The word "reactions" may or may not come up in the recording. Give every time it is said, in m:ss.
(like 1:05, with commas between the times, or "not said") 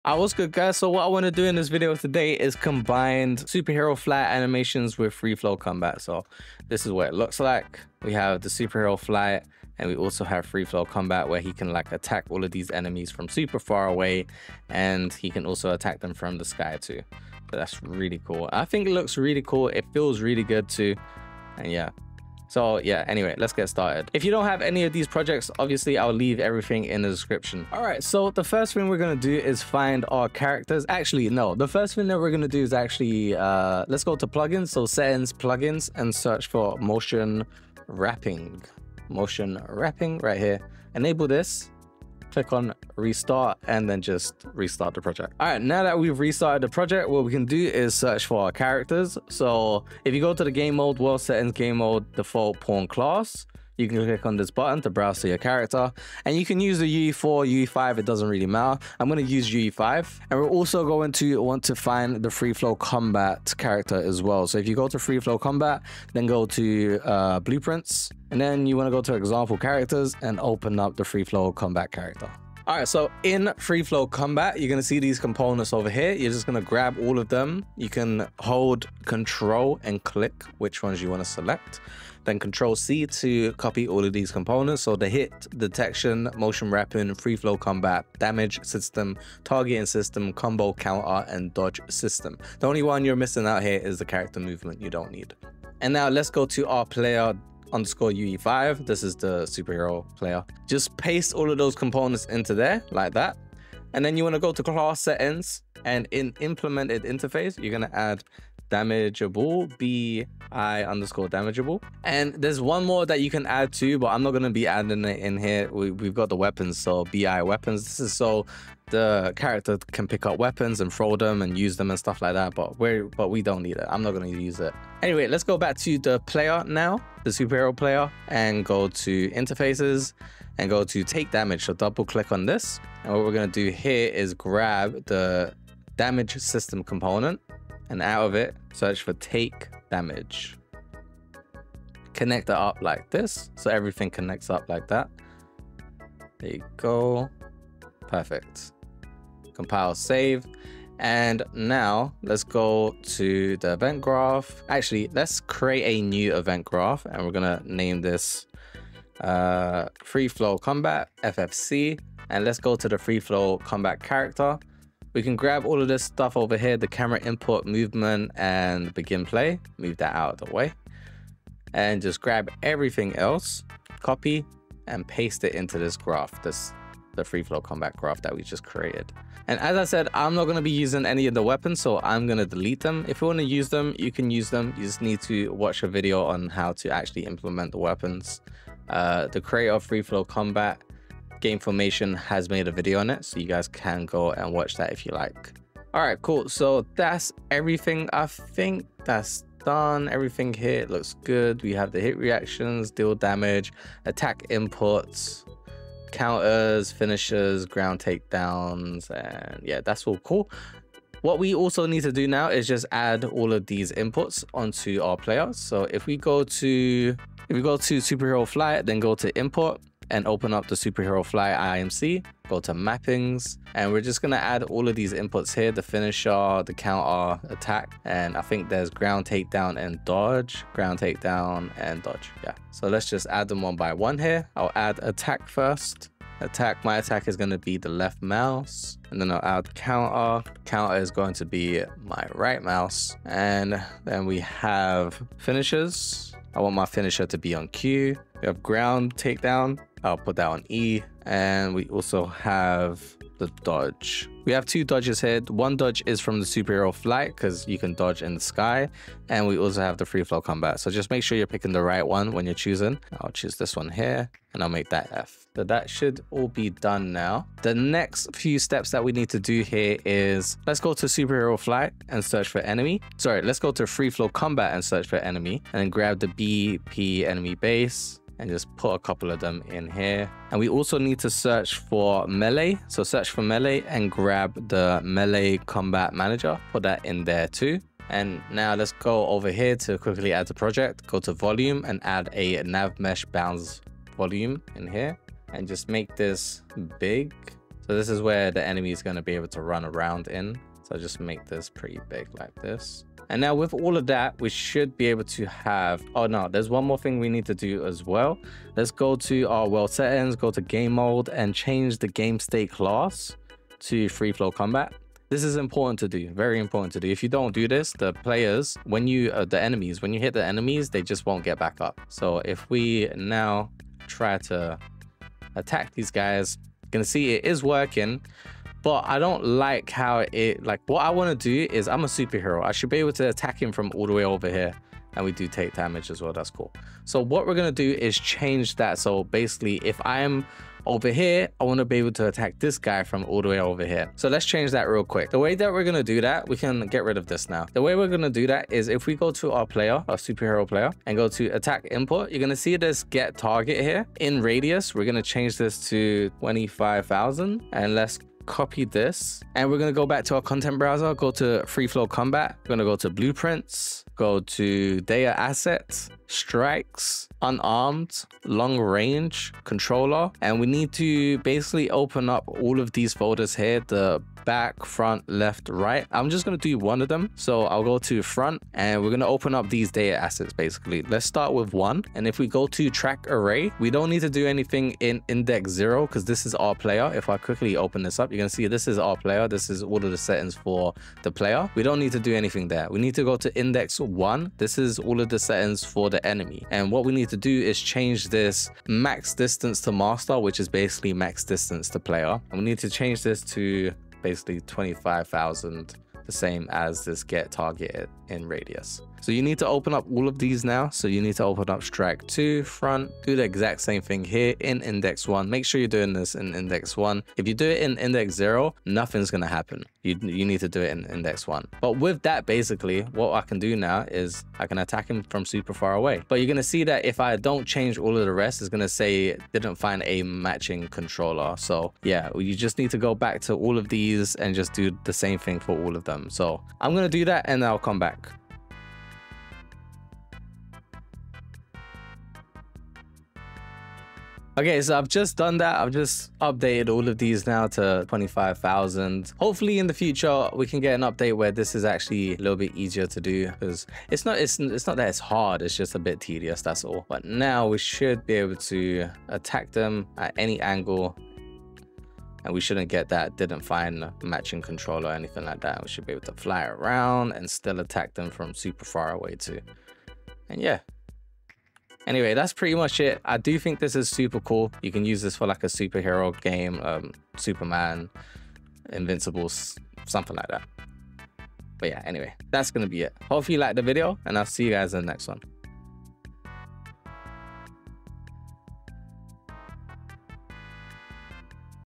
3:22.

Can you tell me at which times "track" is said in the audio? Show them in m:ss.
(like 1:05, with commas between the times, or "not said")
6:22, 6:51.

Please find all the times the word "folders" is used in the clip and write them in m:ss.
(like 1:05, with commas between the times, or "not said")
6:13.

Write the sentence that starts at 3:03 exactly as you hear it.
If you want to use them, you can use them.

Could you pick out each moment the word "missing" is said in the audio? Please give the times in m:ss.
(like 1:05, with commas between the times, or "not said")
1:33.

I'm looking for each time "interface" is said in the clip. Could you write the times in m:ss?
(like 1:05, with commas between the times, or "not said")
1:47, 2:09.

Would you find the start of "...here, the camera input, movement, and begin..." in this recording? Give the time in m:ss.
2:46.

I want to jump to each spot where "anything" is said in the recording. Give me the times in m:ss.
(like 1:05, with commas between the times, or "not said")
6:24, 6:32, 7:45.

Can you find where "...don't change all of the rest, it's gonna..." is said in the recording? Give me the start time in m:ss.
7:07.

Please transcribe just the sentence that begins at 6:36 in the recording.
And what we need to do is change this max distance to master, which is basically max distance to player.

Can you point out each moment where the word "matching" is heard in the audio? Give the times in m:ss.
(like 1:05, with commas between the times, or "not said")
7:10, 7:44.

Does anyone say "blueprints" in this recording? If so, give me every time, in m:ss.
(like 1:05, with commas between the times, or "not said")
1:07, 6:03.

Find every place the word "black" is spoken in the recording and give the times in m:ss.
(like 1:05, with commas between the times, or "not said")
not said.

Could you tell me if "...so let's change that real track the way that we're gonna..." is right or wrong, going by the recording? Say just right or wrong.
wrong.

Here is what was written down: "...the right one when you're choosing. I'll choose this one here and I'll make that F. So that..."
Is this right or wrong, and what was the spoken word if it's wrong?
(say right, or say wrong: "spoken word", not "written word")
right.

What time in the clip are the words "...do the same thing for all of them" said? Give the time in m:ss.
7:14.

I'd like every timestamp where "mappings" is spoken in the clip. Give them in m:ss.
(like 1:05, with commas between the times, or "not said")
3:42.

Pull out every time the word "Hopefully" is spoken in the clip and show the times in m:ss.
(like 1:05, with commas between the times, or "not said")
7:29, 8:03.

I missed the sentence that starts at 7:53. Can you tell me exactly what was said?
I do think this is super cool.